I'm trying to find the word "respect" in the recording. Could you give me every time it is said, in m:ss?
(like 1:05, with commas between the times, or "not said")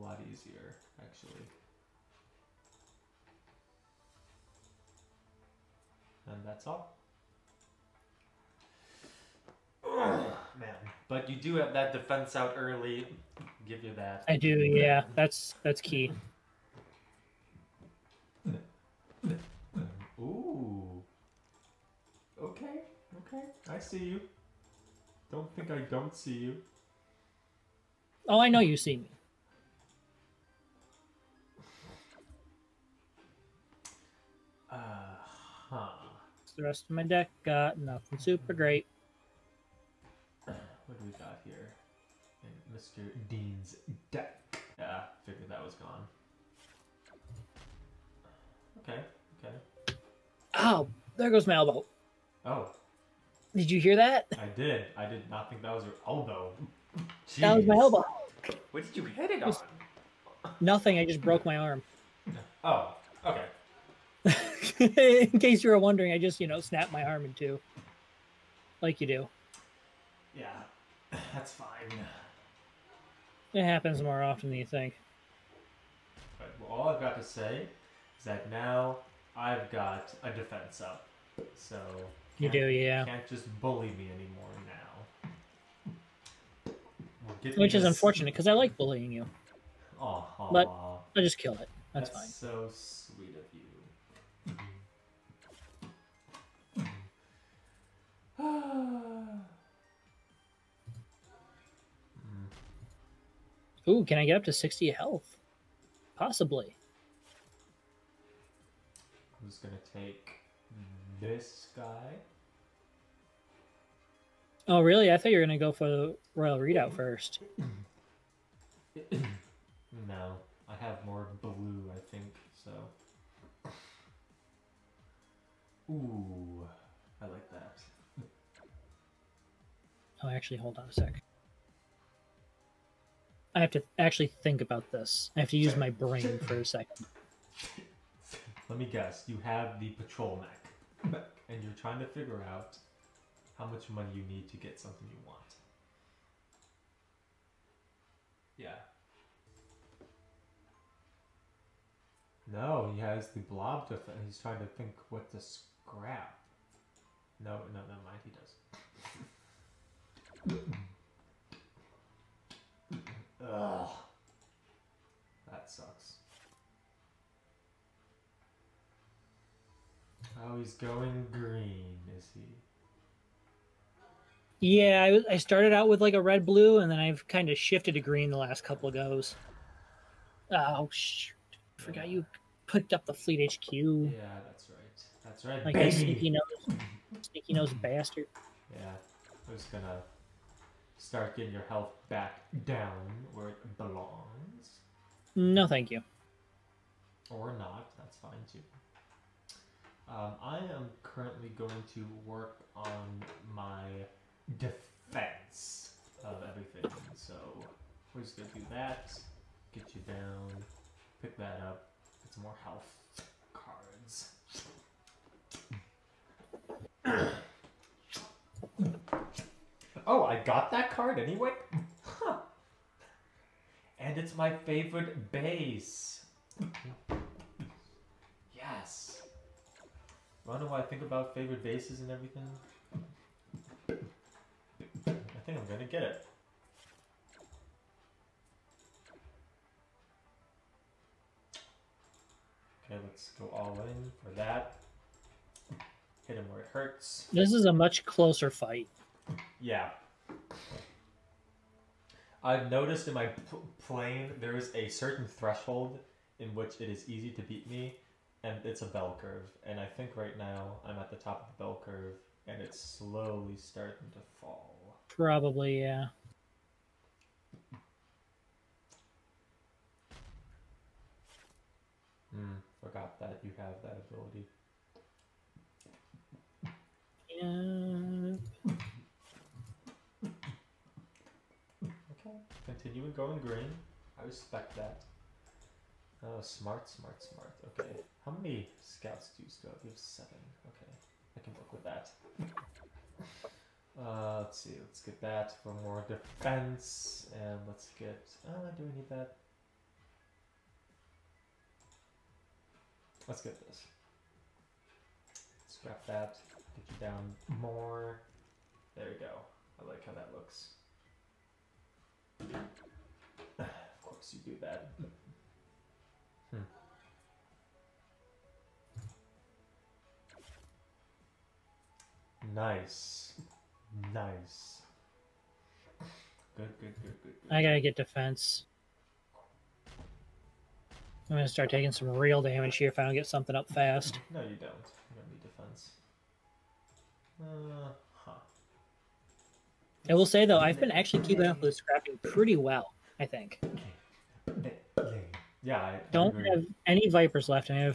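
4:44.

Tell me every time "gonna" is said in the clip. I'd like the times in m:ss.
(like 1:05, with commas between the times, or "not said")
3:09, 3:28, 5:31.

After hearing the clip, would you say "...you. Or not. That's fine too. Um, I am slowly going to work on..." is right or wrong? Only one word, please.
wrong.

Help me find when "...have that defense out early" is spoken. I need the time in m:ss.
0:11.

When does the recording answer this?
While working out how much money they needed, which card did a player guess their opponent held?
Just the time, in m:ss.
2:19.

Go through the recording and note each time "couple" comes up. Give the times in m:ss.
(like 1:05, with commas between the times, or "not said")
2:58.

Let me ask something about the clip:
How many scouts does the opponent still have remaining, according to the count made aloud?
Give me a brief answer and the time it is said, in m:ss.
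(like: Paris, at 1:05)
7, at 4:49.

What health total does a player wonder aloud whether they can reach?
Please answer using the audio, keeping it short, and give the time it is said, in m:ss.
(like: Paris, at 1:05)
60, at 1:44.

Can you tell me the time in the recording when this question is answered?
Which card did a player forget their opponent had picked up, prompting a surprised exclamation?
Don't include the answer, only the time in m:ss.
3:03.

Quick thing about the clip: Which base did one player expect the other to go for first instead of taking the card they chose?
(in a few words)
Royal Redoubt.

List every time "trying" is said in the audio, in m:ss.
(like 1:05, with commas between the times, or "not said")
2:21, 2:34.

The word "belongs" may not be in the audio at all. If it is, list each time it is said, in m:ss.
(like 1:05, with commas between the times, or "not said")
3:13.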